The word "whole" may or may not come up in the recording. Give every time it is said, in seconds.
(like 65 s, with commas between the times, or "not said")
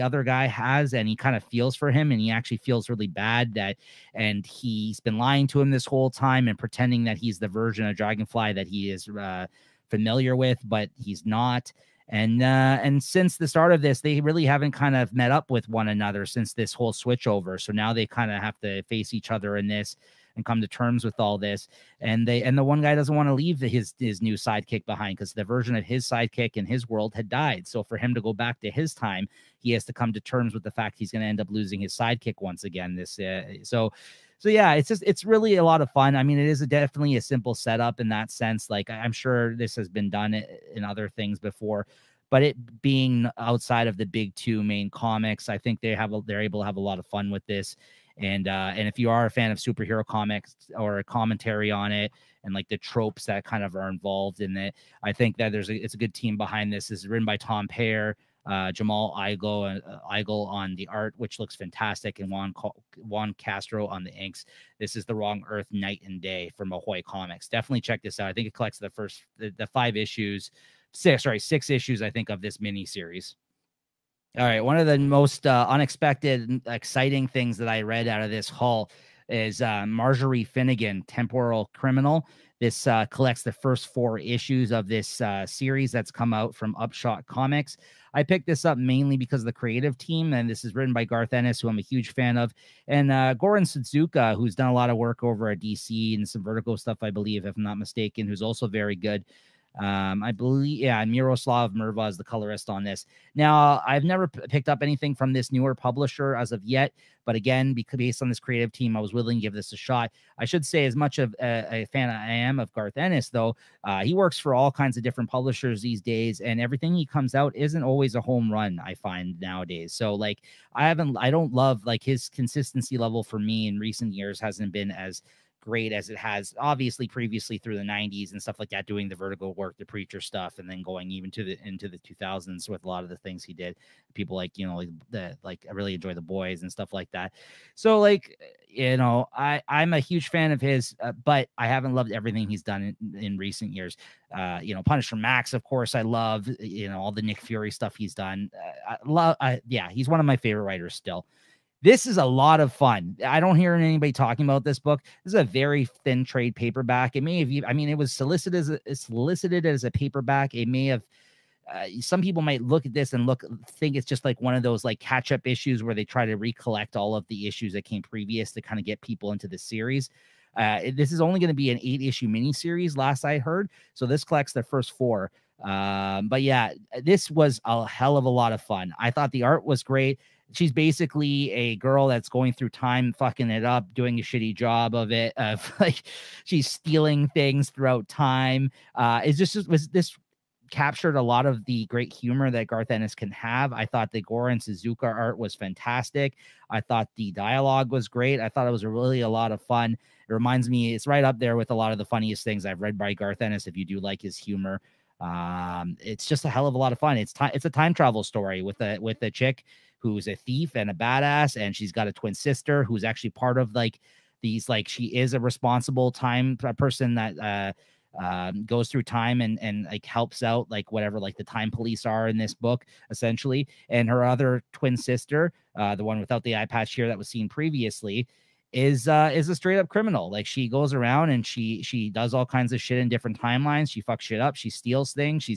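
5 s, 16 s.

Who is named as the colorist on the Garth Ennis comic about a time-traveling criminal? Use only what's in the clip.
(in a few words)
Miroslav Mrva.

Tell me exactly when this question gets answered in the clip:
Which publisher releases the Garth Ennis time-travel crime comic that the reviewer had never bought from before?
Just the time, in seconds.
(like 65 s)
86 s.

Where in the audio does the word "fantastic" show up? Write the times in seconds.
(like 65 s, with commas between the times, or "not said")
61 s, 195 s.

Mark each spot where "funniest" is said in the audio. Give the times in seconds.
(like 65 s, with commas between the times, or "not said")
202 s.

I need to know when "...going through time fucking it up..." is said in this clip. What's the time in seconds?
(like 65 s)
182 s.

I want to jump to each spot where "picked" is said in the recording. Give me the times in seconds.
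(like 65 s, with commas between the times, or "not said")
88 s, 104 s.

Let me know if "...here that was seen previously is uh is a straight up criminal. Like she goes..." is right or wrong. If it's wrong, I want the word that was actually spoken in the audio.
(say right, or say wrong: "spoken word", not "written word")
right.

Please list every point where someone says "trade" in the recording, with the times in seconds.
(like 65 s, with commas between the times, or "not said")
156 s.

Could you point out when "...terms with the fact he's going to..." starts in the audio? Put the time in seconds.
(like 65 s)
30 s.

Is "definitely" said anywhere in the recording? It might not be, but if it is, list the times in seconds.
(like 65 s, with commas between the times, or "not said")
36 s, 67 s.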